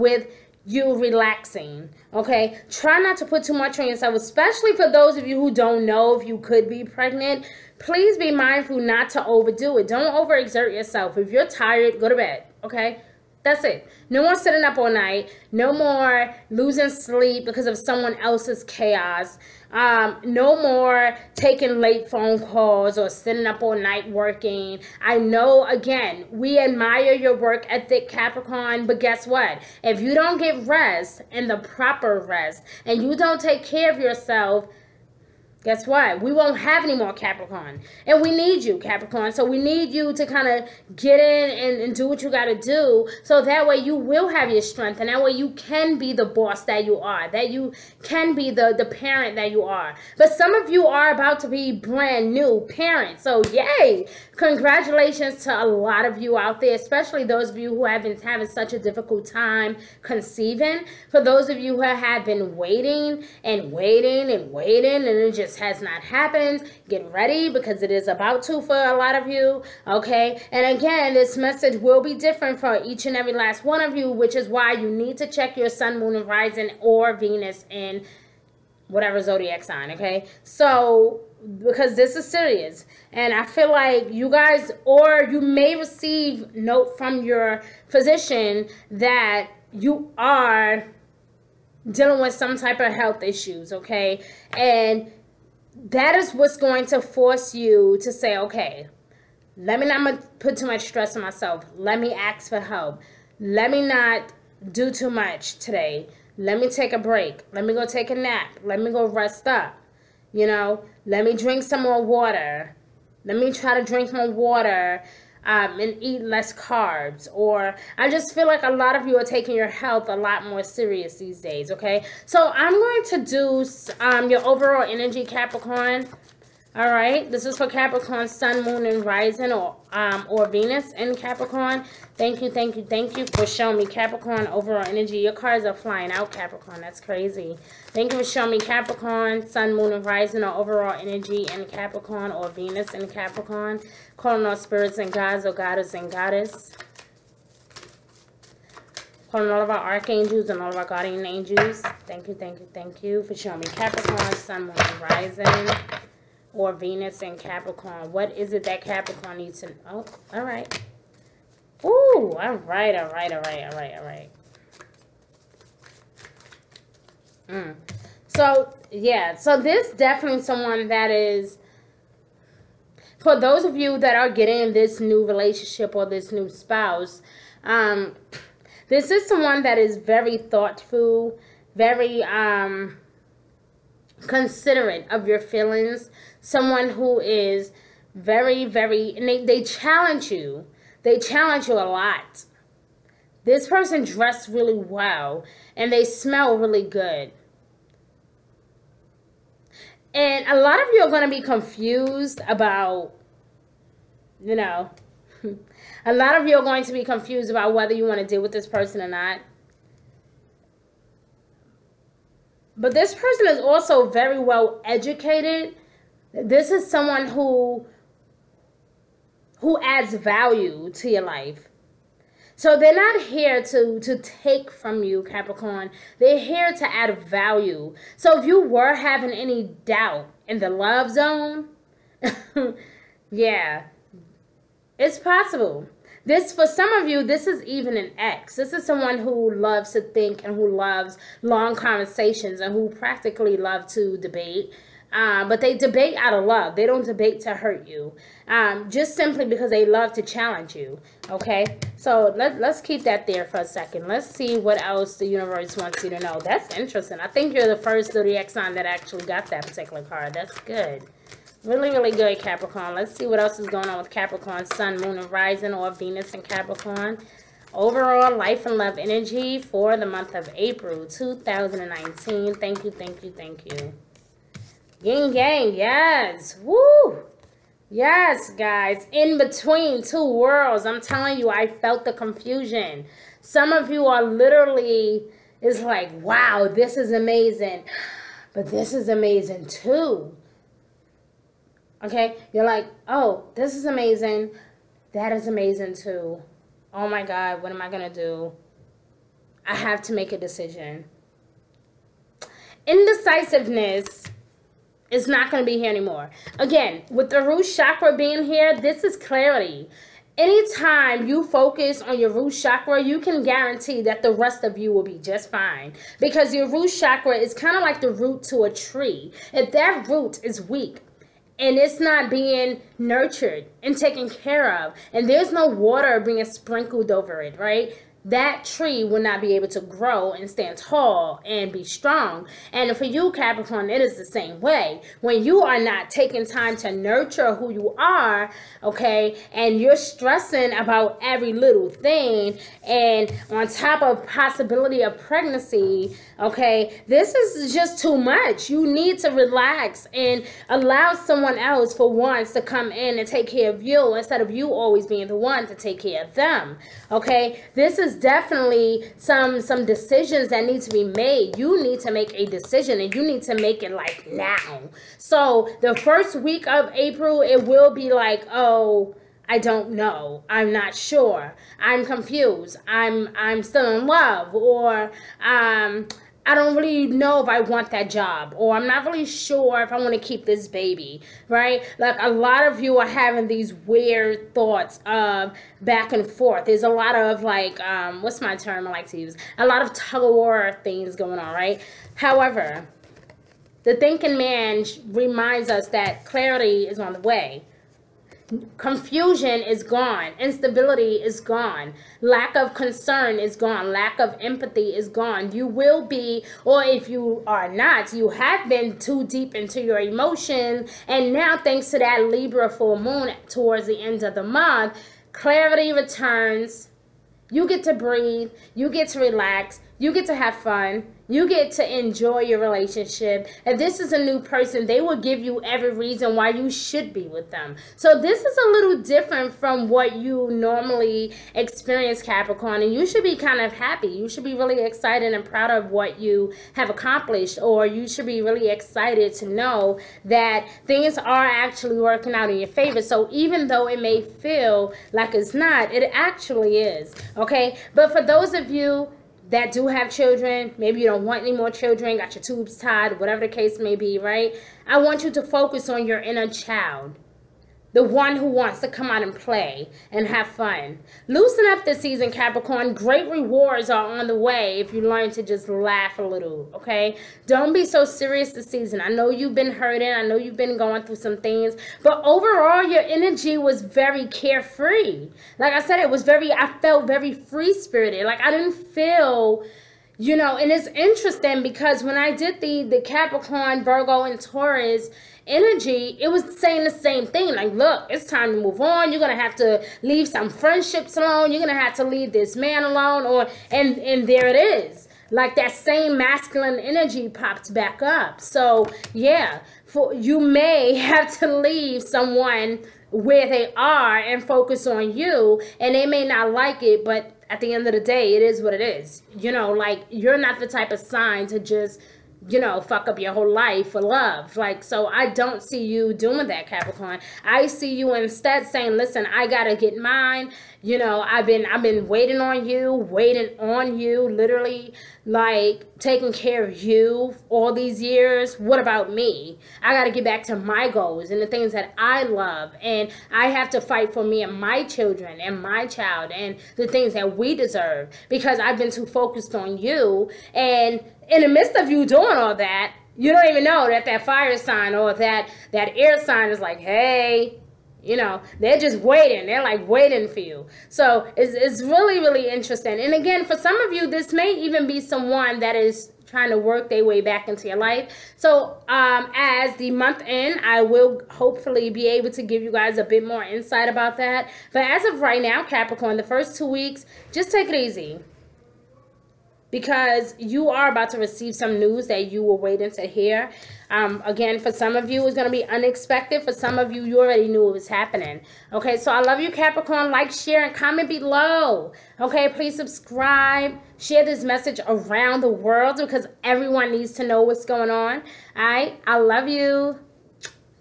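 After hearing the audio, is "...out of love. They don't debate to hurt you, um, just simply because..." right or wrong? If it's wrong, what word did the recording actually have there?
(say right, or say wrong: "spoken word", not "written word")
right.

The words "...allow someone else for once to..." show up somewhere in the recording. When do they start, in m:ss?
5:50.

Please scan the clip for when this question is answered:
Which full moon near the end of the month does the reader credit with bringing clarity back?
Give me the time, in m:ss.
6:52.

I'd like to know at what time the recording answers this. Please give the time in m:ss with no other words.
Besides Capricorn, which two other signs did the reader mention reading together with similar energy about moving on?
8:03.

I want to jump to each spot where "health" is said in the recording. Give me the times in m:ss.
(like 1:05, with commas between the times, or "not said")
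1:32, 1:59.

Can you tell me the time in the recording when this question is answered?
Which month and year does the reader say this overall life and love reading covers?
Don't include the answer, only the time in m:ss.
4:30.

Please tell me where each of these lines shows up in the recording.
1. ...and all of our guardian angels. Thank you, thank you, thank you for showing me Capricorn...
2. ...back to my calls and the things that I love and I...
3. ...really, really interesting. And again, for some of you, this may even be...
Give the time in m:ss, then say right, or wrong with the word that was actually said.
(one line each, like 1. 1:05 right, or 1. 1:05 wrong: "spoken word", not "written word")
1. 2:30 right
2. 8:50 wrong: "goals", not "calls"
3. 9:11 right.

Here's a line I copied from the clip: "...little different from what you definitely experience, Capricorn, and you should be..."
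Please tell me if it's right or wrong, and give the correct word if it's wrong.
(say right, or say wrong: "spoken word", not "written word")
wrong: "normally", not "definitely".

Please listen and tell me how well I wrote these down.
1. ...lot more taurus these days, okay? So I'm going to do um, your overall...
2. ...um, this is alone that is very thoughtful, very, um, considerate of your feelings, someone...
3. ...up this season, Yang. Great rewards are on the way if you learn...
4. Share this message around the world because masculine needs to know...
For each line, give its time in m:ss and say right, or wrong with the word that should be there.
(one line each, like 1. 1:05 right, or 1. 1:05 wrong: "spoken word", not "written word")
1. 2:00 wrong: "serious", not "taurus"
2. 2:57 wrong: "someone", not "alone"
3. 7:41 wrong: "Capricorn", not "Yang"
4. 9:43 wrong: "everyone", not "masculine".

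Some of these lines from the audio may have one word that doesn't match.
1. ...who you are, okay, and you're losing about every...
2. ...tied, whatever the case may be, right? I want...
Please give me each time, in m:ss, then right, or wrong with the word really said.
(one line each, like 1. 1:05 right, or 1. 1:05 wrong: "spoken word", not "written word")
1. 5:37 wrong: "stressing", not "losing"
2. 7:32 right.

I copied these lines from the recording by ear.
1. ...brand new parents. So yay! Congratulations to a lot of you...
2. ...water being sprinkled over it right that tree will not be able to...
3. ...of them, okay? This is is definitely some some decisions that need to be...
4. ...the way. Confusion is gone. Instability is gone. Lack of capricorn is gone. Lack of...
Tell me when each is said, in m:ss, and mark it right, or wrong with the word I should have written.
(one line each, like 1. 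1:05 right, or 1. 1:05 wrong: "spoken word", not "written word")
1. 0:51 right
2. 5:25 right
3. 5:56 right
4. 6:37 wrong: "concern", not "capricorn".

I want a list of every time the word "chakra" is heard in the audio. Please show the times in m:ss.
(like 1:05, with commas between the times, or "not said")
5:07, 5:12, 5:16.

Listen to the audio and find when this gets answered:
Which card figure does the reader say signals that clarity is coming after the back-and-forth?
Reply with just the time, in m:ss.
6:33.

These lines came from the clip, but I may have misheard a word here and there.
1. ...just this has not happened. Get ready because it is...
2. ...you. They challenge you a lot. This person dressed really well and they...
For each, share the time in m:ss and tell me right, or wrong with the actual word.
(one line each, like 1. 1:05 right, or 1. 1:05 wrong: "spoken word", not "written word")
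1. 1:05 right
2. 3:10 right.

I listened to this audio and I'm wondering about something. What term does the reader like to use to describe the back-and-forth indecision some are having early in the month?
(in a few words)
Tug of war.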